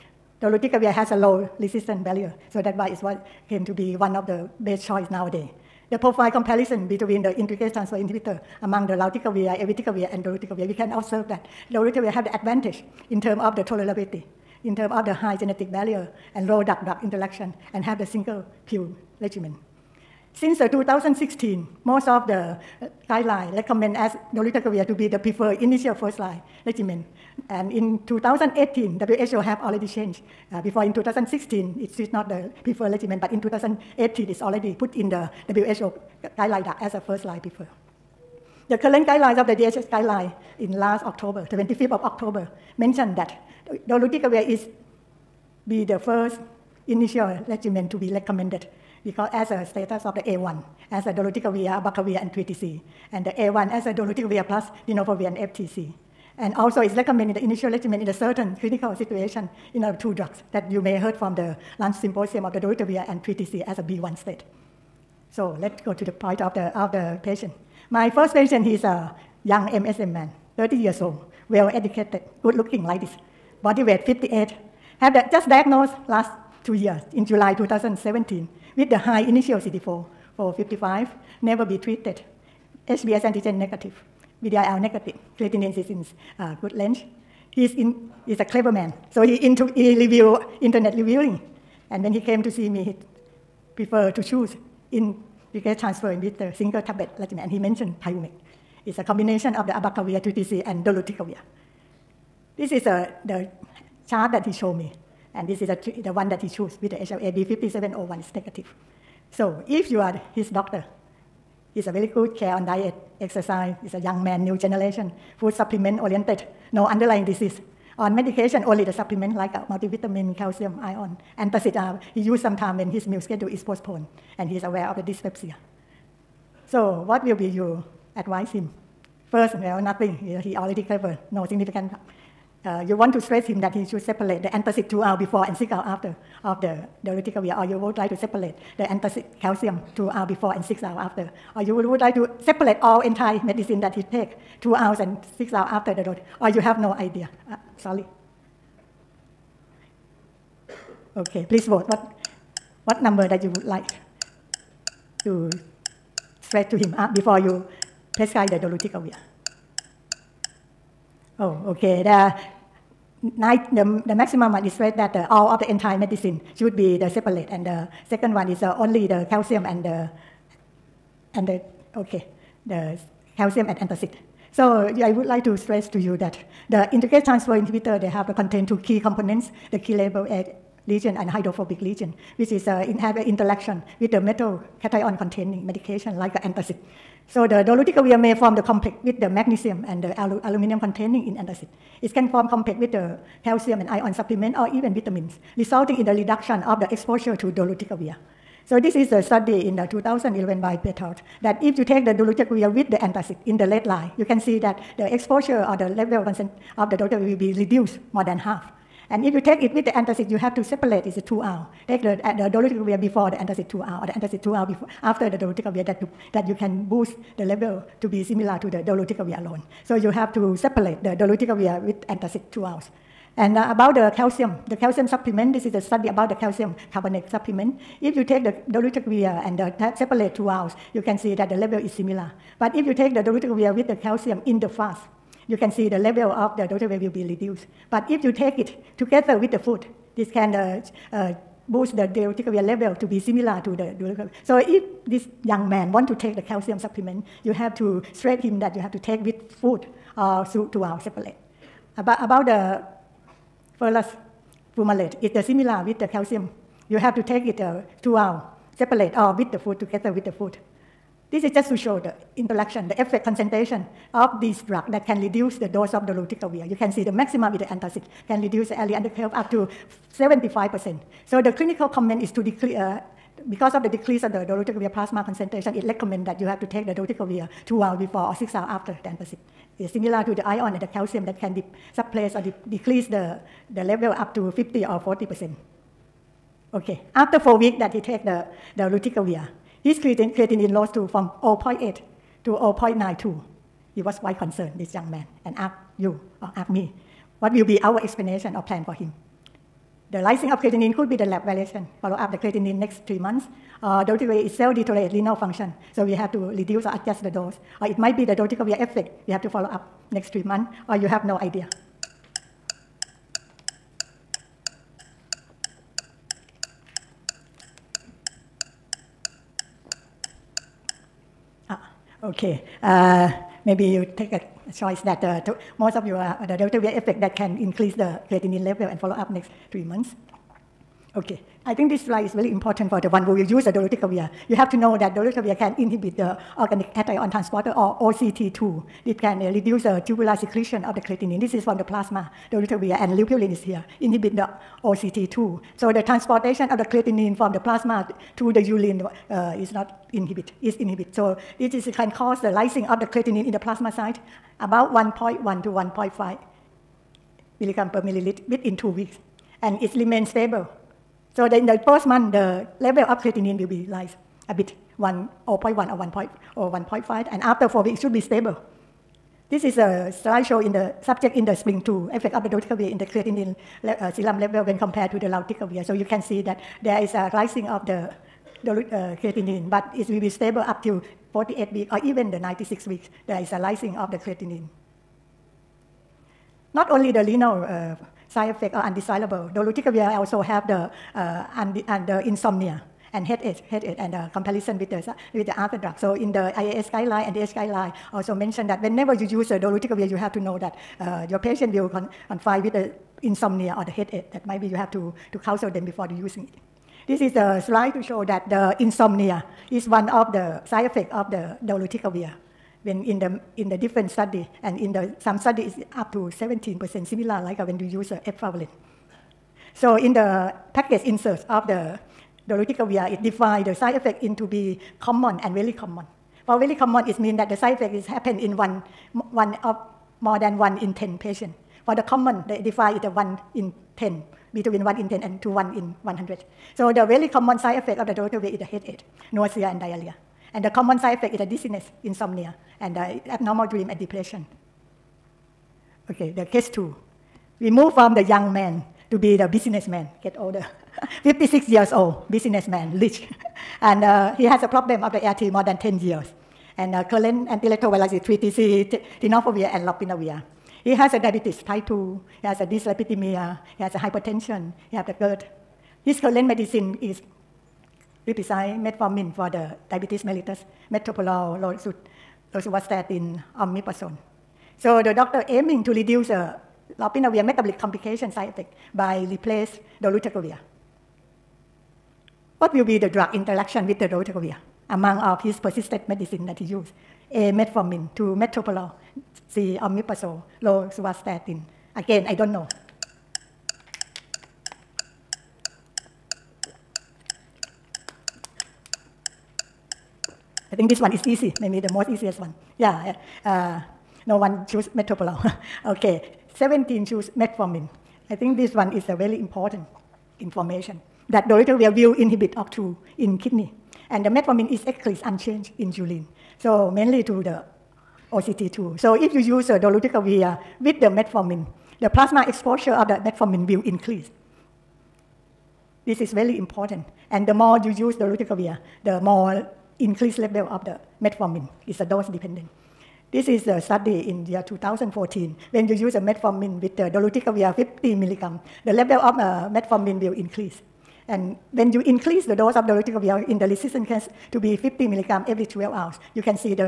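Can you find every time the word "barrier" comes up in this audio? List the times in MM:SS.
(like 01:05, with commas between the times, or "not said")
00:02, 00:15.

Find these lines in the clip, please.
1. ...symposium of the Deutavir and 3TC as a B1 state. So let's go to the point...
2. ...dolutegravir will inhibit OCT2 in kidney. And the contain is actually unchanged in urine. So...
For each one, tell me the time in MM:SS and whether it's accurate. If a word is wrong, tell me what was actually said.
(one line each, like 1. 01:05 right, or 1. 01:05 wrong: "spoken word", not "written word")
1. 01:01 right
2. 08:31 wrong: "metformin", not "contain".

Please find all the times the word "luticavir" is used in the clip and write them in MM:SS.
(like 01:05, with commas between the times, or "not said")
04:26, 04:48.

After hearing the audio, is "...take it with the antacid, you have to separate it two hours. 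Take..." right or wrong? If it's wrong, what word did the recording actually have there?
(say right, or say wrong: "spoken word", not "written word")
right.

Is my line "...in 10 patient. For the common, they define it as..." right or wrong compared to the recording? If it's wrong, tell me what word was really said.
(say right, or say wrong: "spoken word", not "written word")
right.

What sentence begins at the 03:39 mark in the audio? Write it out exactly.
So you have to separate the dolutegravir with antacid two hours.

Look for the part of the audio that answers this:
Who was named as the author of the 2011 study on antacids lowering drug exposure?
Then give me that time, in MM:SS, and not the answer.
03:20.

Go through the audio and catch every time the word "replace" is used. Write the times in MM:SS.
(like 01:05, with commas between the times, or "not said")
07:59.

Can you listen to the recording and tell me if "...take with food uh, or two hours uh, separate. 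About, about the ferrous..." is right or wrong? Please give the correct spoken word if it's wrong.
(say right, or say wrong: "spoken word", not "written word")
right.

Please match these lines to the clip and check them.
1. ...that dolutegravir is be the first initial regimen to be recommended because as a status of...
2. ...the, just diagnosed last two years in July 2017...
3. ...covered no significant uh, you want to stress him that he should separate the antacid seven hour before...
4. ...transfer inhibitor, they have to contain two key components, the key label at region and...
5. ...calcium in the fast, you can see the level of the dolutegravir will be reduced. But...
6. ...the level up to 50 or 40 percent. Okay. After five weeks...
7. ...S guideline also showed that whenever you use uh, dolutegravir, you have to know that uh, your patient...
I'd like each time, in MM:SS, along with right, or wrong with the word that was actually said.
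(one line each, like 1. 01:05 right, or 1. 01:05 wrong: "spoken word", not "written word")
1. 00:43 right
2. 01:15 right
3. 02:10 wrong: "two", not "seven"
4. 02:57 right
5. 03:53 right
6. 04:43 wrong: "four", not "five"
7. 06:37 wrong: "mentioned", not "showed".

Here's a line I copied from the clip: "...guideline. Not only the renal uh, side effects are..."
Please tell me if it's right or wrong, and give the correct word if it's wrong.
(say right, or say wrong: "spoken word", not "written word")
wrong: "creatinine", not "guideline".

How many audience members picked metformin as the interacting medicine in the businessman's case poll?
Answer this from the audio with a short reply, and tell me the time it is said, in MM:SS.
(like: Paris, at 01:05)
17, at 08:26.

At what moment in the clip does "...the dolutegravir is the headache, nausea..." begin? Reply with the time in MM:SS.
07:18.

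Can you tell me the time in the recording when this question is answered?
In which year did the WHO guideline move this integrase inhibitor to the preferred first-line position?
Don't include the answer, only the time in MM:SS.
00:33.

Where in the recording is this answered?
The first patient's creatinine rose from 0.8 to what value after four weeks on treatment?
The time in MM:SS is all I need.
04:52.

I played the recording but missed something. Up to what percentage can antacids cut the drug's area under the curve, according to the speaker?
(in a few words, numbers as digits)
75%.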